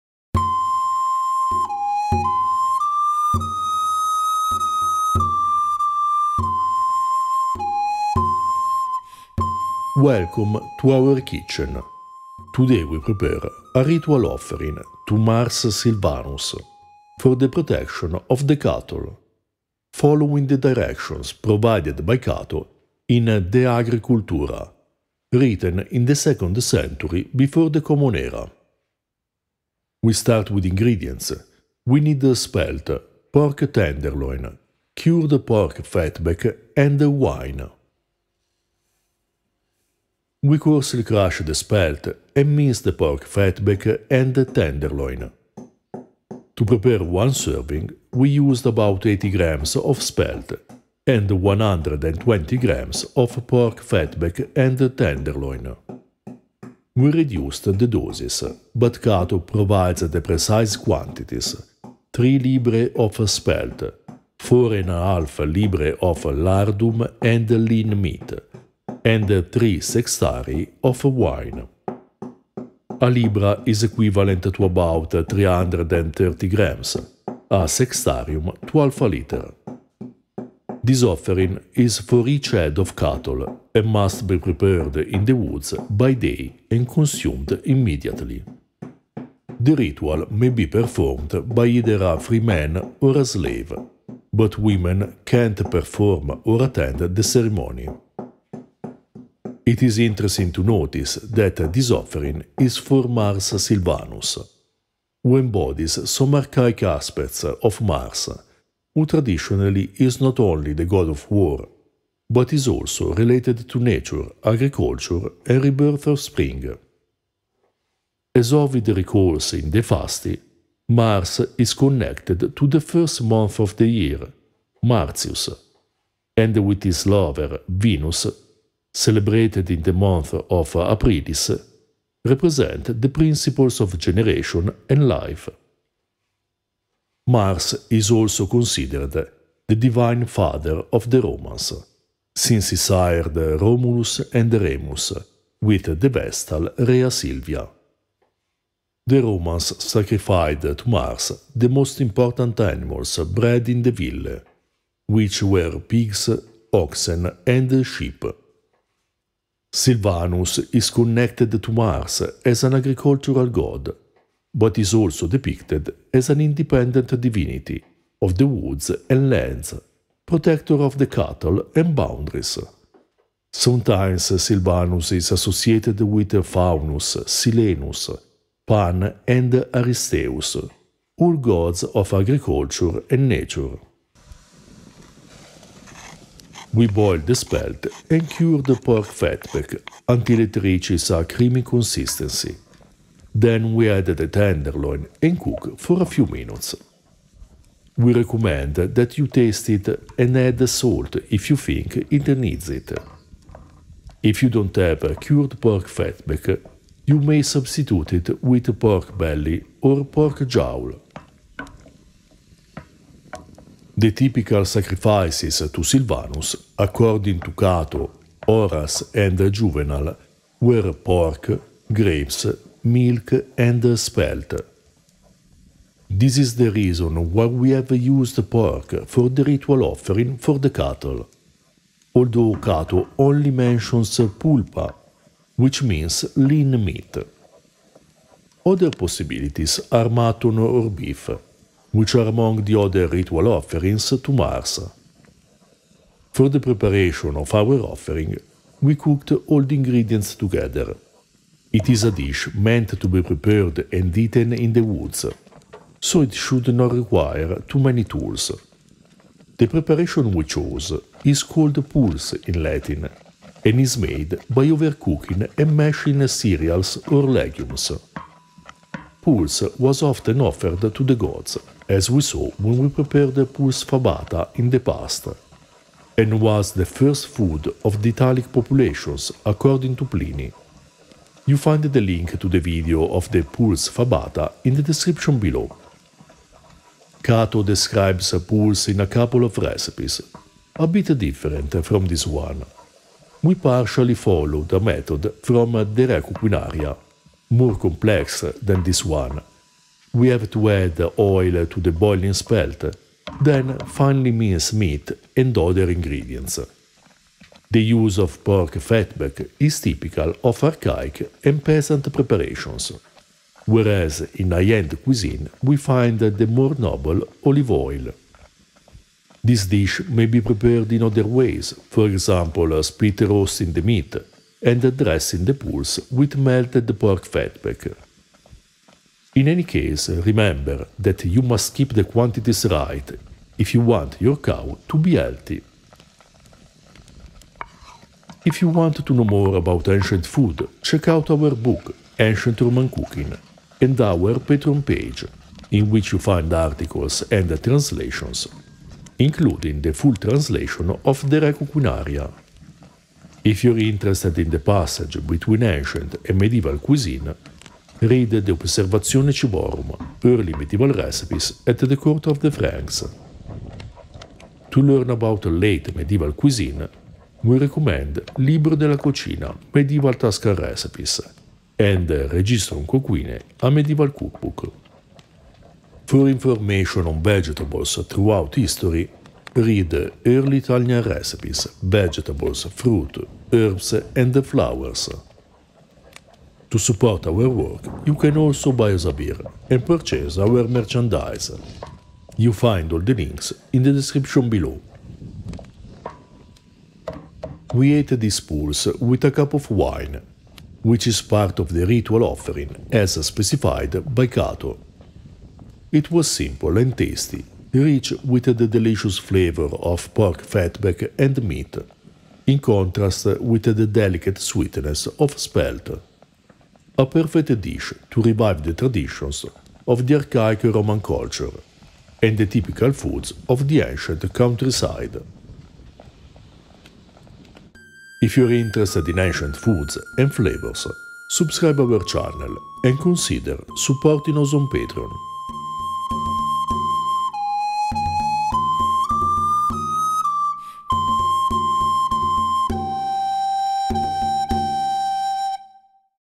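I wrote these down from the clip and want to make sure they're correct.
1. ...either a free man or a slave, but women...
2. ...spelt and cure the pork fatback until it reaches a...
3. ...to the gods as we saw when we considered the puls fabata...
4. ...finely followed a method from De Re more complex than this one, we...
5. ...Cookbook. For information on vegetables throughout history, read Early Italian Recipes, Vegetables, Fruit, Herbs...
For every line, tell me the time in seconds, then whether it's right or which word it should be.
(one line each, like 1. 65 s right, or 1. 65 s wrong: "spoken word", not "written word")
1. 91 s right
2. 187 s right
3. 270 s wrong: "prepared", not "considered"
4. 293 s wrong: "partially", not "finely"
5. 374 s right.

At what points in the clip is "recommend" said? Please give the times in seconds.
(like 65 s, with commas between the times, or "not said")
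198 s, 367 s.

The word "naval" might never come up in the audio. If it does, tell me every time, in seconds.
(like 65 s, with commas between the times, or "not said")
not said.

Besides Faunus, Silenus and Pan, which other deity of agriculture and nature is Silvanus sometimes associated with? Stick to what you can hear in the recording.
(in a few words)
Aristeus.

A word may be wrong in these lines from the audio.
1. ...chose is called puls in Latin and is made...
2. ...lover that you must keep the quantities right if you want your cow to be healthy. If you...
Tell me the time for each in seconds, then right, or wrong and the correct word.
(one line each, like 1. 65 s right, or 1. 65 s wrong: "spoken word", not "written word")
1. 260 s right
2. 330 s wrong: "remember", not "lover".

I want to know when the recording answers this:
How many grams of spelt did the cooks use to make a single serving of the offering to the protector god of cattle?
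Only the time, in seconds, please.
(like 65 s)
49 s.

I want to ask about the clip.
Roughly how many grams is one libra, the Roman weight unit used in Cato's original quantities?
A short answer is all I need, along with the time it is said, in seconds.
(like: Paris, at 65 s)
330 grams, at 75 s.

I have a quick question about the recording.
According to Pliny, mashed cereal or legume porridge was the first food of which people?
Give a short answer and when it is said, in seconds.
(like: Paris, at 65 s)
Italic populations, at 278 s.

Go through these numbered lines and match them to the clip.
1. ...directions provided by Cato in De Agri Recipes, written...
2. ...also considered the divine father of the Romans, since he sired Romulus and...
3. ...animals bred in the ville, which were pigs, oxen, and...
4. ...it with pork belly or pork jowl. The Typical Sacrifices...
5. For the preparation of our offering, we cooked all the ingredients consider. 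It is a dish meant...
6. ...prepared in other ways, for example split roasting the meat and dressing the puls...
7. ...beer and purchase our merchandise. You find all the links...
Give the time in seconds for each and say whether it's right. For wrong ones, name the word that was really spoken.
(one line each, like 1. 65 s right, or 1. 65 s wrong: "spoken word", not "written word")
1. 20 s wrong: "Cultura", not "Recipes"
2. 138 s right
3. 152 s right
4. 208 s right
5. 246 s wrong: "together", not "consider"
6. 320 s right
7. 389 s right.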